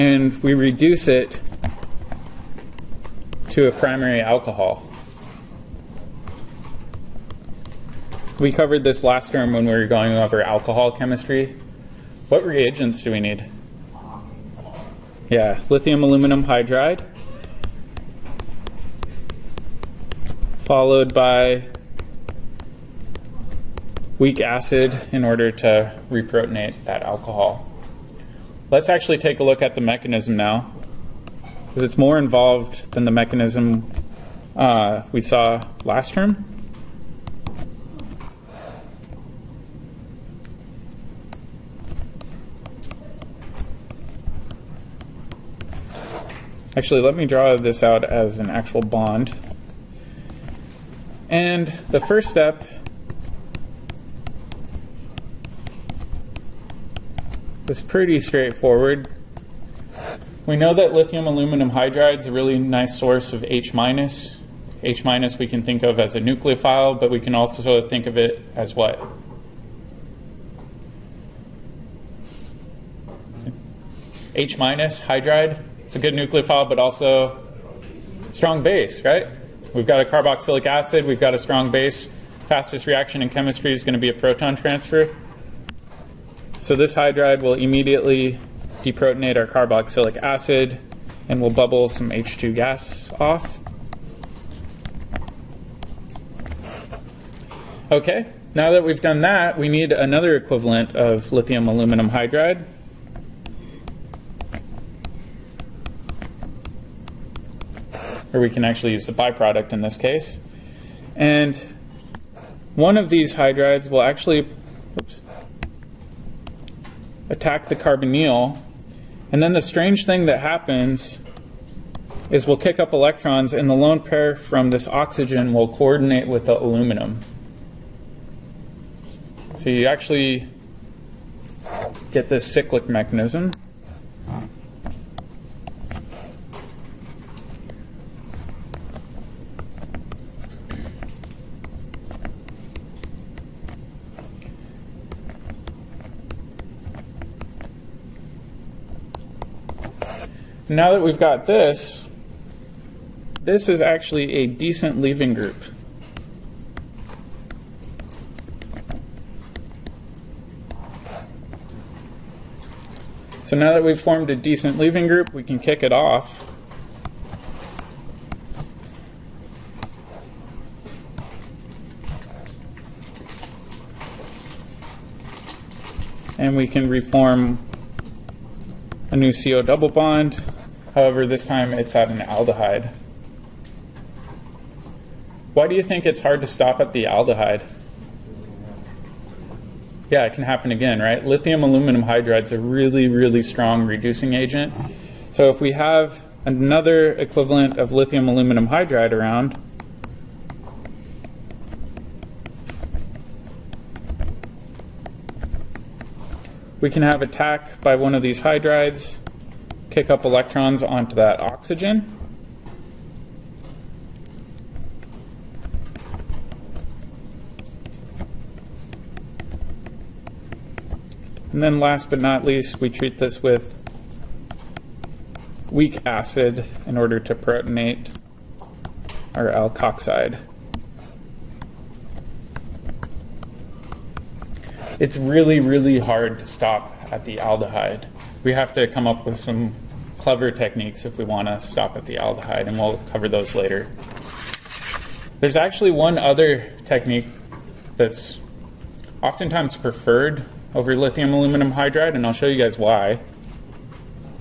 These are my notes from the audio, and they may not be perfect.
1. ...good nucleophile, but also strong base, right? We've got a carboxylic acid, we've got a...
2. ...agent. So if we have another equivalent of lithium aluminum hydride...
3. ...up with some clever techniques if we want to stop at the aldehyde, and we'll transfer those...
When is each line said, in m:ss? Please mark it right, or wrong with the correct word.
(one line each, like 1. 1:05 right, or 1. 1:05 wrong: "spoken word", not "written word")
1. 1:15 right
2. 3:14 right
3. 3:59 wrong: "cover", not "transfer".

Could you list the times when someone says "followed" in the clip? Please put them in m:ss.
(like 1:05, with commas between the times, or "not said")
0:20.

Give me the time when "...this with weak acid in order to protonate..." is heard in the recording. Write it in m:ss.
3:43.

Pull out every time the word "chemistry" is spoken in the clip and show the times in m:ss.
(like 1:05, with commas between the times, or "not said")
0:10, 1:23.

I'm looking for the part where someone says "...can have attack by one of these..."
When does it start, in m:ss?
3:26.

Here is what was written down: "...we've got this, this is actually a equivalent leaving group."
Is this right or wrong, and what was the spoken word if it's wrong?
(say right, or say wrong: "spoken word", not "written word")
wrong: "decent", not "equivalent".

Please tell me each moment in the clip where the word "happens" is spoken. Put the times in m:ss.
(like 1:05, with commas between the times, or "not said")
2:00, 3:10.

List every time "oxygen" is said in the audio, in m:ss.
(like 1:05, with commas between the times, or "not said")
2:04, 3:31.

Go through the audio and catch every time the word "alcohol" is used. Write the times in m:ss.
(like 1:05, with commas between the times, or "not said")
0:04, 0:10, 0:27.